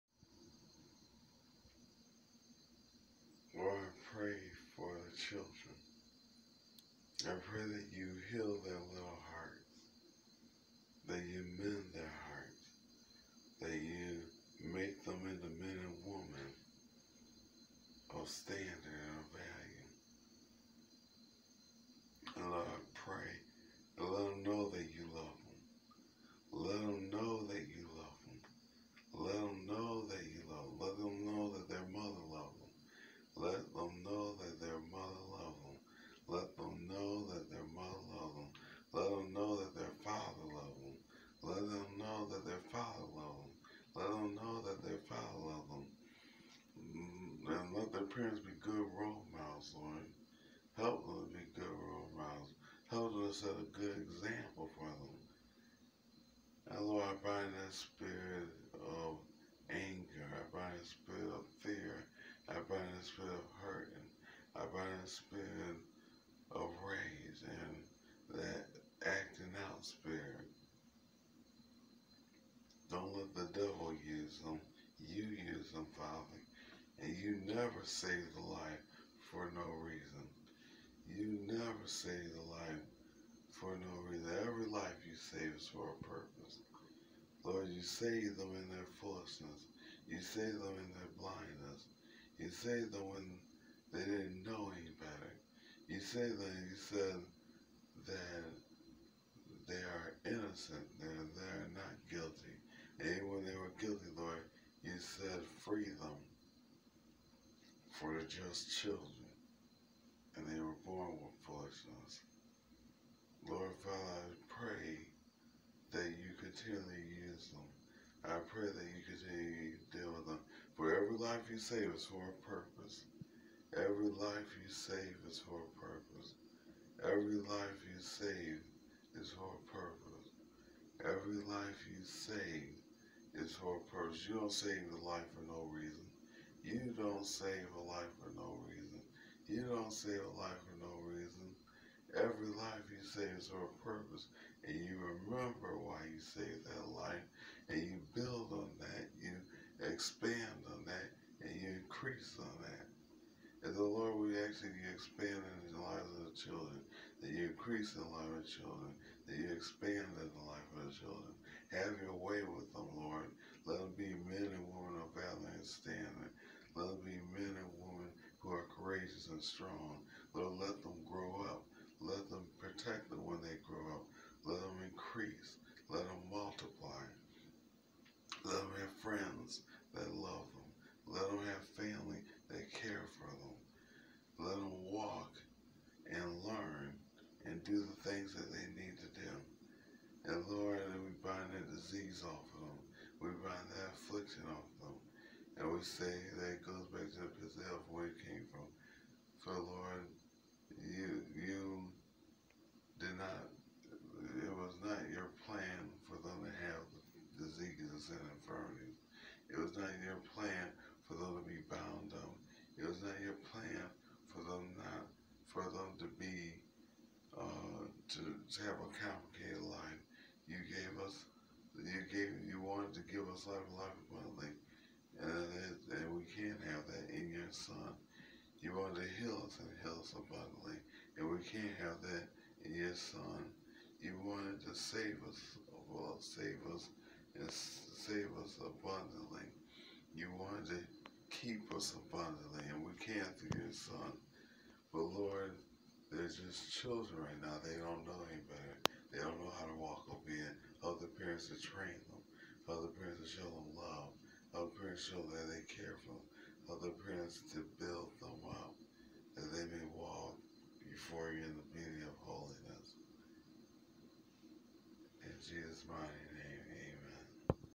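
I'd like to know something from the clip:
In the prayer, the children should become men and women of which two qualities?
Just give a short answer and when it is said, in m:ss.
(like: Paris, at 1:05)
valor and standing, at 2:45.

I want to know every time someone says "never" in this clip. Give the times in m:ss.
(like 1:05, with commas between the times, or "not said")
1:17, 1:21.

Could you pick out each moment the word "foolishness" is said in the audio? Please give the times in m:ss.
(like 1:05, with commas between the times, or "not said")
1:28, 1:51.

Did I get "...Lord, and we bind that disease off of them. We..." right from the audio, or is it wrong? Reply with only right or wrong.
right.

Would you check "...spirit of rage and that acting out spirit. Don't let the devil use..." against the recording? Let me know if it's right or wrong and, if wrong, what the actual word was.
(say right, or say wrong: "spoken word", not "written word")
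right.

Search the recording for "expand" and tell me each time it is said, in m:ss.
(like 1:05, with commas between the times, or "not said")
2:29, 2:34, 2:39.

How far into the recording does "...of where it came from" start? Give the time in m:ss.
3:17.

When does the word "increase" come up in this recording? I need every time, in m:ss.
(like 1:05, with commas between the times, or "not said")
2:31, 2:37, 2:54.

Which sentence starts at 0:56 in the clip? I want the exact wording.
And Lord, I bind that spirit of anger.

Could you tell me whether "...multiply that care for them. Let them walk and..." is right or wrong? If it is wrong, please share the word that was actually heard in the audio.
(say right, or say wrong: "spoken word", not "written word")
wrong: "family", not "multiply".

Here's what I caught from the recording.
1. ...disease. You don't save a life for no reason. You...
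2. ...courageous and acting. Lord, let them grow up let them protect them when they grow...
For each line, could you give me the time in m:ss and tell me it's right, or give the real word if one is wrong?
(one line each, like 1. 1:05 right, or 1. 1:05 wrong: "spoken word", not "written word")
1. 2:13 wrong: "purpose", not "disease"
2. 2:48 wrong: "strong", not "acting".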